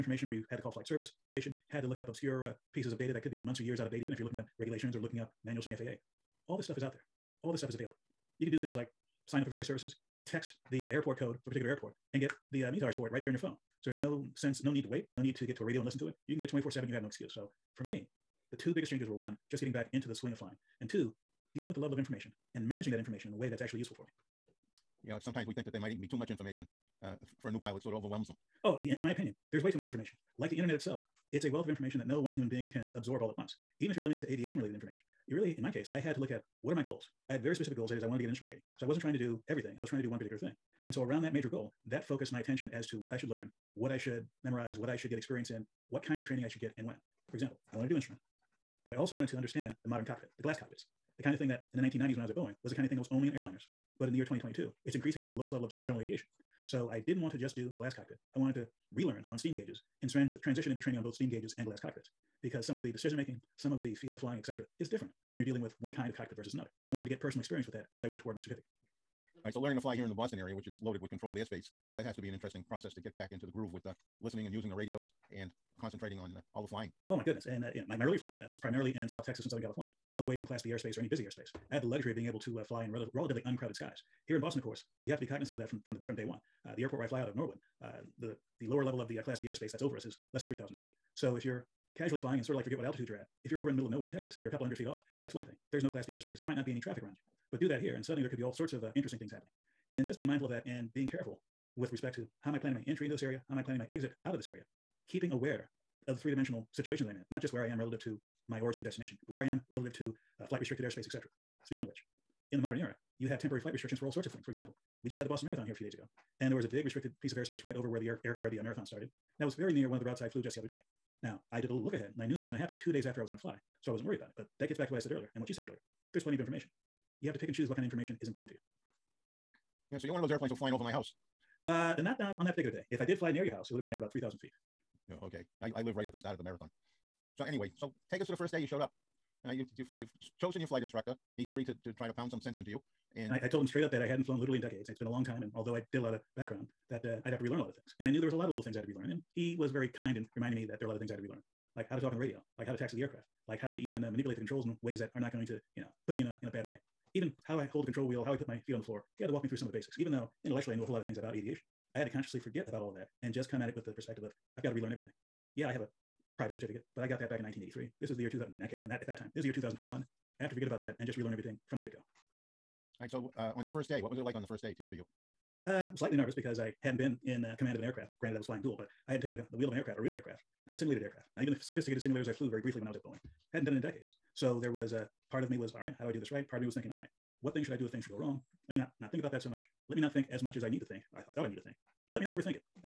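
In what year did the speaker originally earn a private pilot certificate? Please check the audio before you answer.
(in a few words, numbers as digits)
1983.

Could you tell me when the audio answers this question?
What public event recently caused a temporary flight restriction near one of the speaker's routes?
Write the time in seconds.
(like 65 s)
115 s.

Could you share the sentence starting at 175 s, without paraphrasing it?
Uh, slightly nervous because I hadn't been in uh, command of an aircraft.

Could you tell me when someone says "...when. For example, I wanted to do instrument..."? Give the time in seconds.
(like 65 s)
46 s.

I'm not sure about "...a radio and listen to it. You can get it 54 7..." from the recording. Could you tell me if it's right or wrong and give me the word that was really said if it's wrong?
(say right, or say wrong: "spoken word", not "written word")
wrong: "24", not "54".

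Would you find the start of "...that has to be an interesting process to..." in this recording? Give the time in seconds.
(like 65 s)
71 s.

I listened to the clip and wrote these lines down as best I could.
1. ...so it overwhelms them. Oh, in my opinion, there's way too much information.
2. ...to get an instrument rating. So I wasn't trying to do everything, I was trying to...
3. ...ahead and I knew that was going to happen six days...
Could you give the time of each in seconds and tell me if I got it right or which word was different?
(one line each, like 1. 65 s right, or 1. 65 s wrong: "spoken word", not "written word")
1. 27 s right
2. 38 s right
3. 121 s wrong: "two", not "six".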